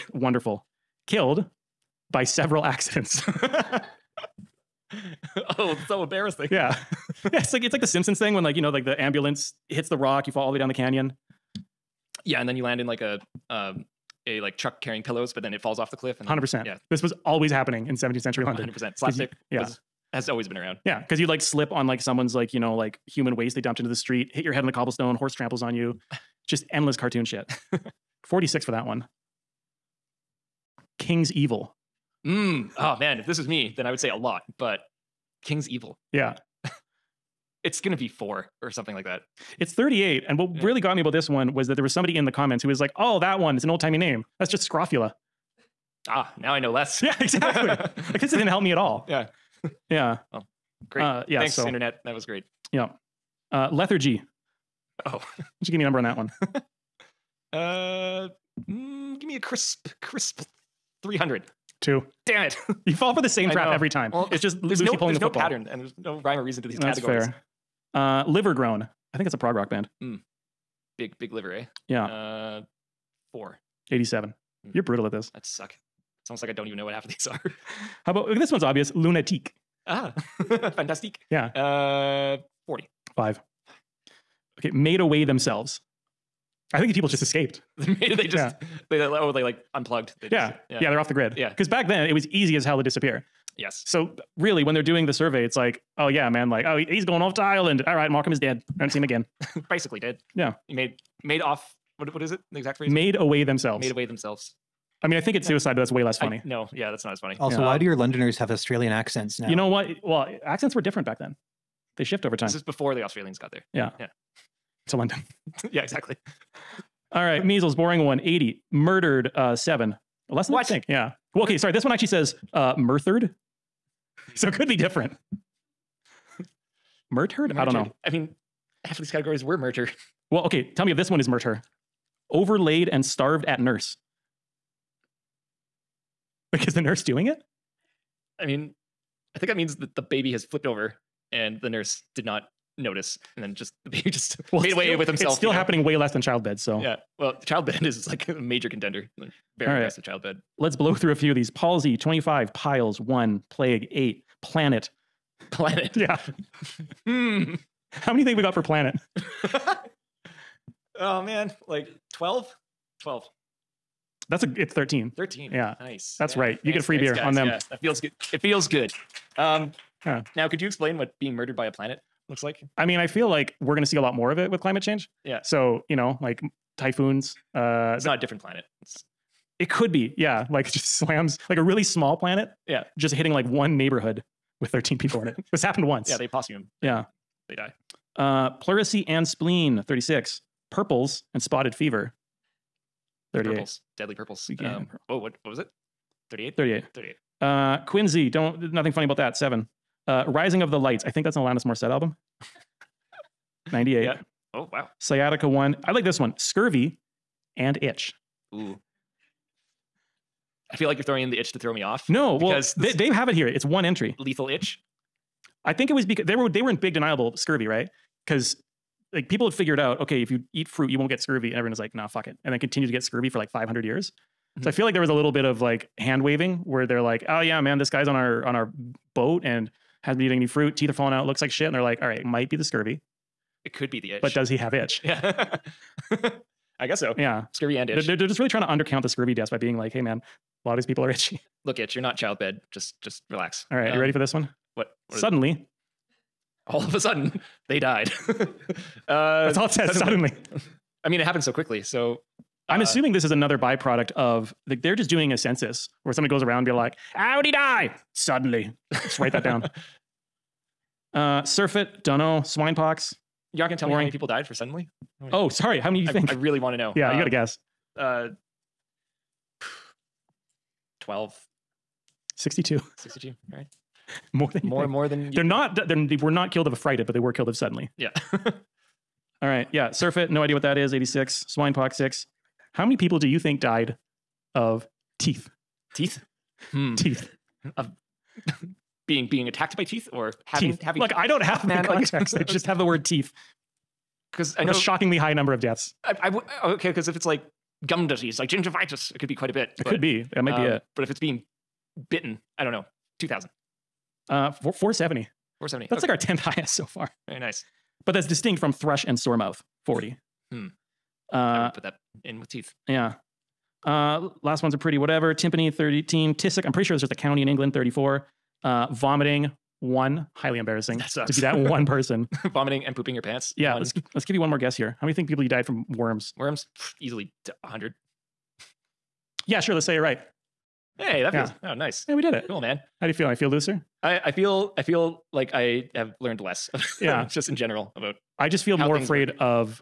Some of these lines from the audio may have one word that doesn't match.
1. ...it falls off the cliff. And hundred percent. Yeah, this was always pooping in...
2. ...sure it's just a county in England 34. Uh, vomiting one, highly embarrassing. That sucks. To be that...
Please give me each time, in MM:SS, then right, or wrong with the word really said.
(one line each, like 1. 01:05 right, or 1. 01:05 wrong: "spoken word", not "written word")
1. 00:15 wrong: "happening", not "pooping"
2. 05:16 right.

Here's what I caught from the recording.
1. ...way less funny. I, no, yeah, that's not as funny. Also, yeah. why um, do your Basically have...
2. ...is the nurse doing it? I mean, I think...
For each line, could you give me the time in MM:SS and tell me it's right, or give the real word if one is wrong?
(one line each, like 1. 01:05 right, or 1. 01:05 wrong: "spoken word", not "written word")
1. 01:45 wrong: "Londoners", not "Basically"
2. 02:16 right.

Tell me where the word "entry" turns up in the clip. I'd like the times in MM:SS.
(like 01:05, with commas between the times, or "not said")
03:33.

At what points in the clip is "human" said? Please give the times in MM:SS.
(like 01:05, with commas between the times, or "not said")
00:23.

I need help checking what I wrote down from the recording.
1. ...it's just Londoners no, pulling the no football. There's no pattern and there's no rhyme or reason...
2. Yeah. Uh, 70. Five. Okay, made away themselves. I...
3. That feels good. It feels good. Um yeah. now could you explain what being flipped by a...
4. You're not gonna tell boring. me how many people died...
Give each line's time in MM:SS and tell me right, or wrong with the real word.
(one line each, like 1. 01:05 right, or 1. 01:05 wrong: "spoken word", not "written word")
1. 01:04 wrong: "Lucy", not "Londoners"
2. 01:21 wrong: "40", not "70"
3. 02:47 wrong: "murdered", not "flipped"
4. 04:23 right.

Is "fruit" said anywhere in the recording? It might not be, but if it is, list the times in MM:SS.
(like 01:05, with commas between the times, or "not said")
03:40, 03:50.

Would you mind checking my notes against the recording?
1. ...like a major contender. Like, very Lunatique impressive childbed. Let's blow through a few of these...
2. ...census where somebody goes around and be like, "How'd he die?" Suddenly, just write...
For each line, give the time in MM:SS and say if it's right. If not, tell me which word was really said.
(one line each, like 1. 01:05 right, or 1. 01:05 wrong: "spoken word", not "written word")
1. 02:28 wrong: "All", not "Lunatique"
2. 04:15 right.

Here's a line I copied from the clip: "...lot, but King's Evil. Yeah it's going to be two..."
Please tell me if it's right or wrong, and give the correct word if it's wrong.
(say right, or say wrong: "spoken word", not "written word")
wrong: "four", not "two".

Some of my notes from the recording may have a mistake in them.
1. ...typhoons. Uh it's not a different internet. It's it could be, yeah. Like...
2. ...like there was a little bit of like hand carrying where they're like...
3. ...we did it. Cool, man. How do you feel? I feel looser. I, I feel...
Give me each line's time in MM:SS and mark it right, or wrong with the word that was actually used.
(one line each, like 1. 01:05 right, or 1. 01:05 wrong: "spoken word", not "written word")
1. 02:56 wrong: "planet", not "internet"
2. 03:44 wrong: "waving", not "carrying"
3. 05:32 right.